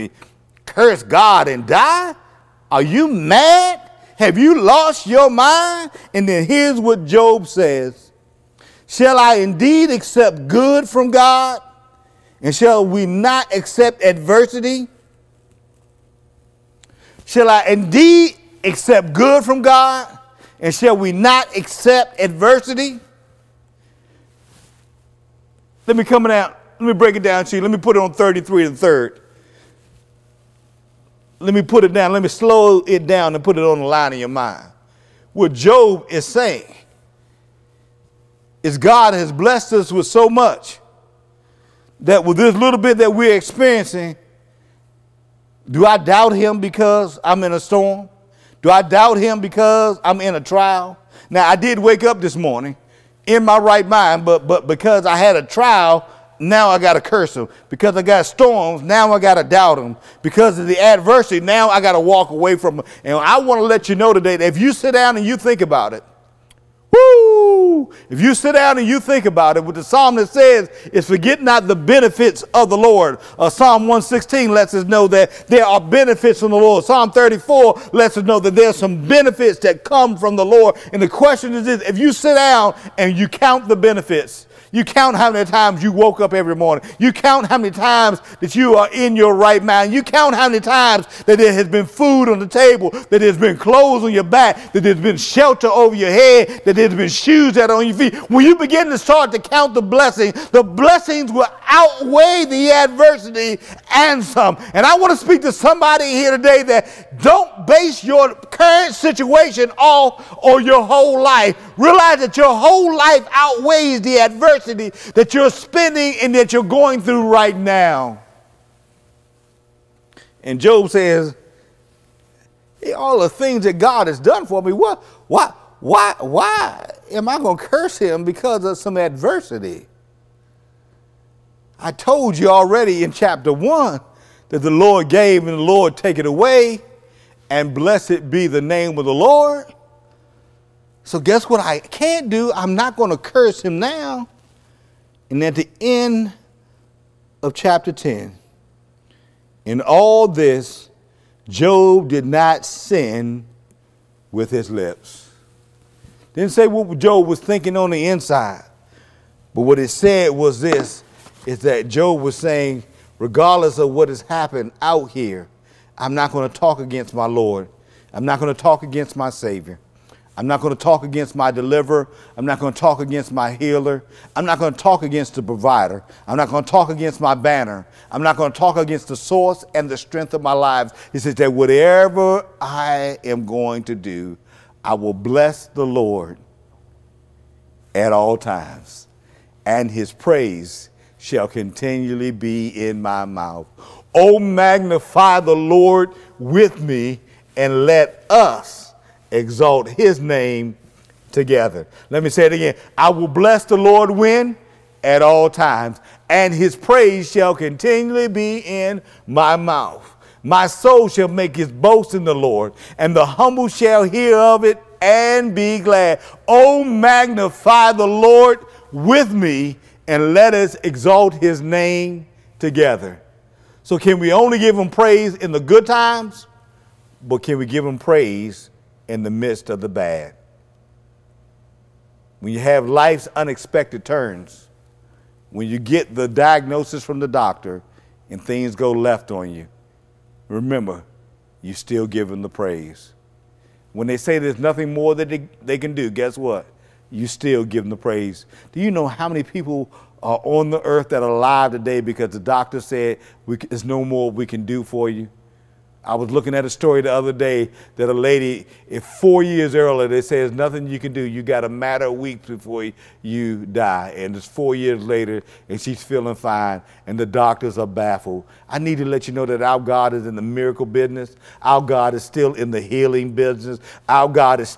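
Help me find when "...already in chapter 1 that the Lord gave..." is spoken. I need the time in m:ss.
2:12.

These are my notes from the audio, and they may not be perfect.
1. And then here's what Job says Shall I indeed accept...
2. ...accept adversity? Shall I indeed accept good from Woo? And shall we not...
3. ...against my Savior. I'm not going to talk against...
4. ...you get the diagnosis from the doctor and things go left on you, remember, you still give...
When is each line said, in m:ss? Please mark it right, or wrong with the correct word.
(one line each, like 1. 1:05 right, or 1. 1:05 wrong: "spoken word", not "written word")
1. 0:06 right
2. 0:13 wrong: "God", not "Woo"
3. 2:48 right
4. 3:55 right.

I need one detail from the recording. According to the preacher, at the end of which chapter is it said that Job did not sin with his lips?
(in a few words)
10.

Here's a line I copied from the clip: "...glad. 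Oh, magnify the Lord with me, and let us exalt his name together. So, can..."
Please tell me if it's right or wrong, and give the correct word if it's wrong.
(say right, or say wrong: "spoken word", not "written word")
right.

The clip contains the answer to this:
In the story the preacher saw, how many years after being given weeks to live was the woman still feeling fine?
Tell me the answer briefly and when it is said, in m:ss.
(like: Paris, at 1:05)
4, at 4:24.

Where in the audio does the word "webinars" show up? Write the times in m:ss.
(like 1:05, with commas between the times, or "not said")
not said.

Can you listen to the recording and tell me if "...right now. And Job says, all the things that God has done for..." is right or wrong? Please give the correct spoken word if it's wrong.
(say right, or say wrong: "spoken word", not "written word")
right.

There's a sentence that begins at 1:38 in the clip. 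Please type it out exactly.
When you begin to start to count the blessings, the blessings will outweigh the adversity and some.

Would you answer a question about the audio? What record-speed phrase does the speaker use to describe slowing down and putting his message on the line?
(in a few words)
33 and 3rd.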